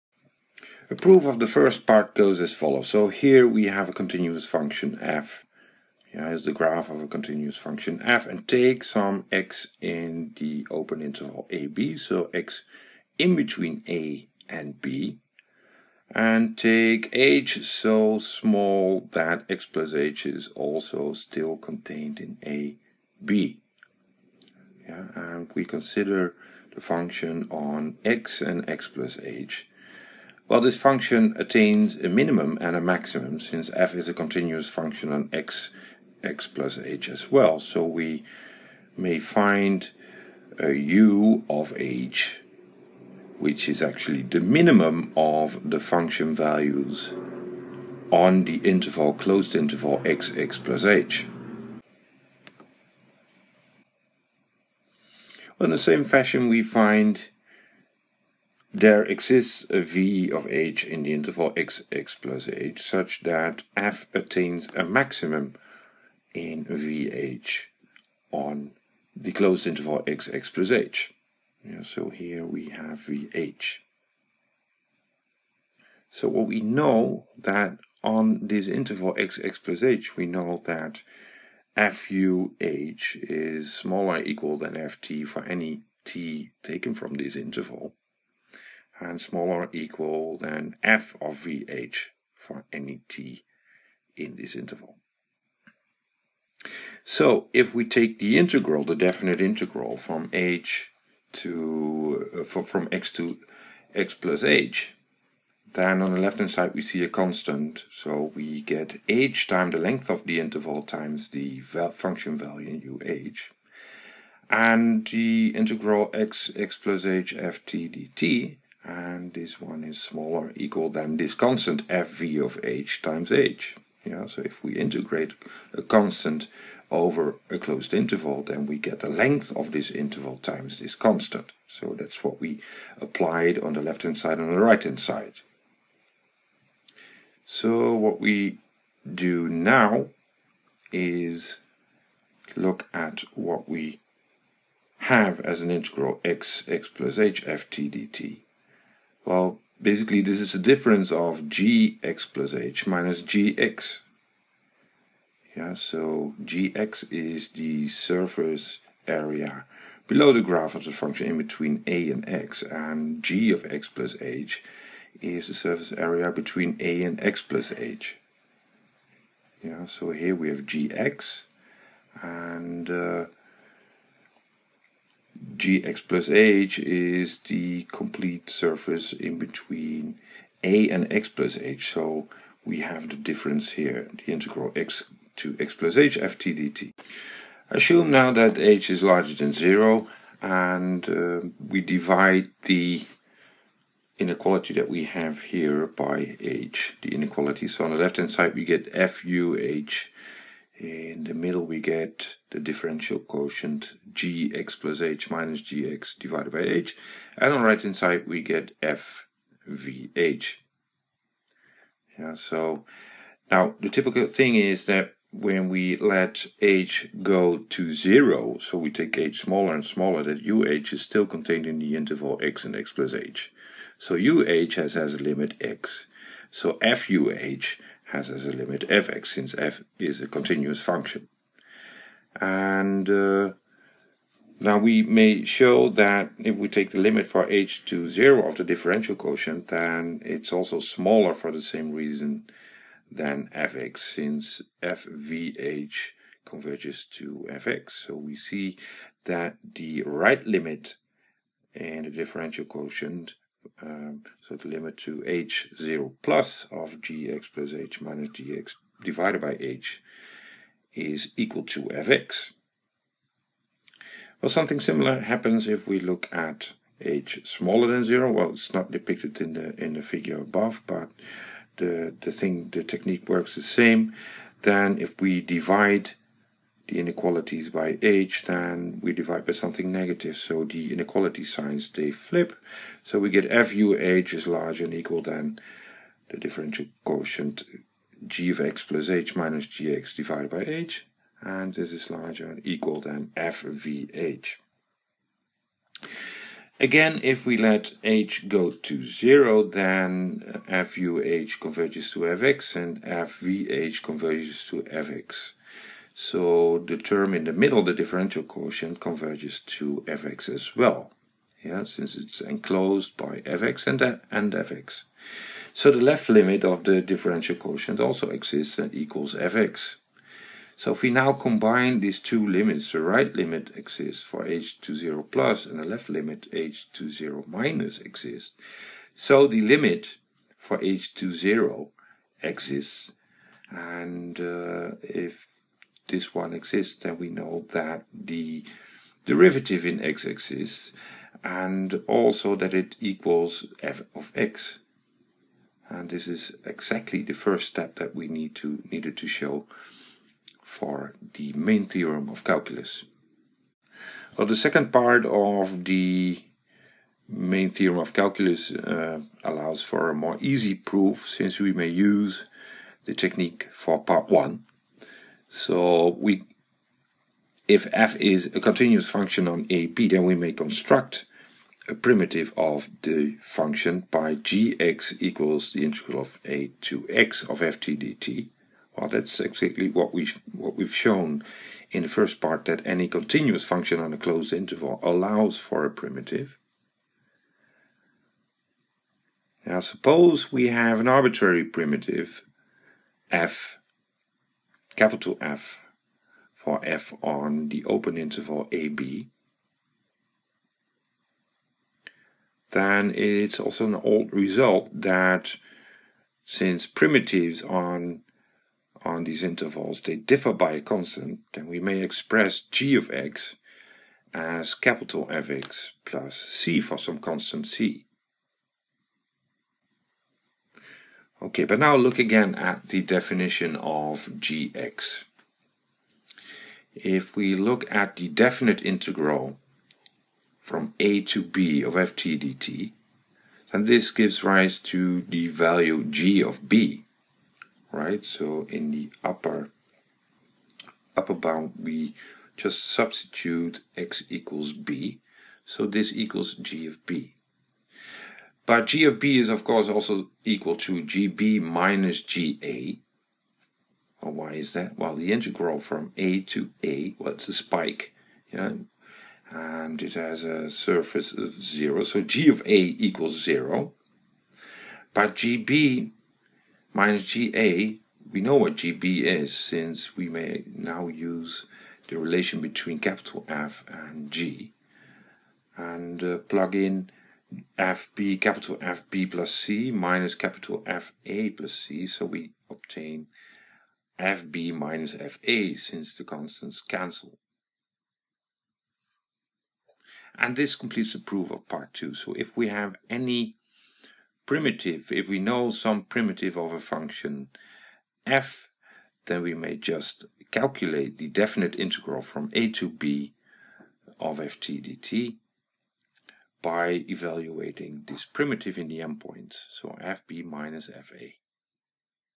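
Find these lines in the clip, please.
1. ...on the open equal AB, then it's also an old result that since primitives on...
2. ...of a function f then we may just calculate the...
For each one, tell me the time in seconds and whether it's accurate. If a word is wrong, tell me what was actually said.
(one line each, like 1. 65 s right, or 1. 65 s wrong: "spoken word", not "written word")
1. 397 s wrong: "interval", not "equal"
2. 496 s right.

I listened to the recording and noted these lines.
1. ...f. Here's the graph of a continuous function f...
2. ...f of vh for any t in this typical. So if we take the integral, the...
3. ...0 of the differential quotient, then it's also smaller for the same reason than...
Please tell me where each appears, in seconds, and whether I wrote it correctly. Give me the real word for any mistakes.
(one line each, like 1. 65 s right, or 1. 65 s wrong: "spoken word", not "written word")
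1. 4 s right
2. 90 s wrong: "interval", not "typical"
3. 238 s right.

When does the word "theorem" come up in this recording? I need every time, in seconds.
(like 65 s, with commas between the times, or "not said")
351 s, 357 s.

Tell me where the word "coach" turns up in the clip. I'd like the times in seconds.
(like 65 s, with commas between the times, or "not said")
not said.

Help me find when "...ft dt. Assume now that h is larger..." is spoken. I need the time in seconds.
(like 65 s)
186 s.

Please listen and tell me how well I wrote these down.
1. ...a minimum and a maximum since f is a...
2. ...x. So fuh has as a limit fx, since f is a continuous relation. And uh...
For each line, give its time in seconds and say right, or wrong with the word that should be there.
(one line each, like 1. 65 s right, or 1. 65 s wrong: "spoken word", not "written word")
1. 31 s right
2. 225 s wrong: "function", not "relation".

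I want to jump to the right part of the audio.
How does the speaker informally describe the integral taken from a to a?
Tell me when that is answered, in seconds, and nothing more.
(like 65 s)
457 s.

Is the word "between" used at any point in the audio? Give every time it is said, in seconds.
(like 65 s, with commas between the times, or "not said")
13 s, 161 s, 166 s, 179 s, 472 s.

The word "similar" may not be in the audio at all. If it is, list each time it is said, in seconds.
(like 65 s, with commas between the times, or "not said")
264 s.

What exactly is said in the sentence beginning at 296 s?
Again, if we let h go to 0, then fuh converges to fx and fvh converges to fx.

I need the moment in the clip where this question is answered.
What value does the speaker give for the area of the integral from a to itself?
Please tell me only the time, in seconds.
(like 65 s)
460 s.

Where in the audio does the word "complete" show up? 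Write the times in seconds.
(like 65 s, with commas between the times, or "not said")
177 s, 490 s.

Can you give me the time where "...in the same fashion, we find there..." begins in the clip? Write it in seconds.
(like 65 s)
55 s.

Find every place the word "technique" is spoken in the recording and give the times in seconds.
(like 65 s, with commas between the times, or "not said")
272 s, 363 s.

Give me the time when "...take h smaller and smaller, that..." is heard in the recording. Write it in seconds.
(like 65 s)
218 s.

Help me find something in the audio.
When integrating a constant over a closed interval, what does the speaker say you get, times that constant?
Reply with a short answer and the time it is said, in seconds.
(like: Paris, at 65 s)
the length of this interval, at 129 s.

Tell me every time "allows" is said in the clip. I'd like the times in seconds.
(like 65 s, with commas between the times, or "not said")
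359 s, 385 s.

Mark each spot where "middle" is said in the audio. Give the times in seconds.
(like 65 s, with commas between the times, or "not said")
201 s, 307 s.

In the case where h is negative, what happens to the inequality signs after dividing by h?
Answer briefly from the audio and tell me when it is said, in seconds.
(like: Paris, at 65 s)
they flip, at 281 s.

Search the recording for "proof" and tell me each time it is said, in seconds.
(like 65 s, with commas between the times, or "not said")
0 s, 360 s, 491 s.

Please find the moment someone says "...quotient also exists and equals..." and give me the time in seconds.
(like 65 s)
317 s.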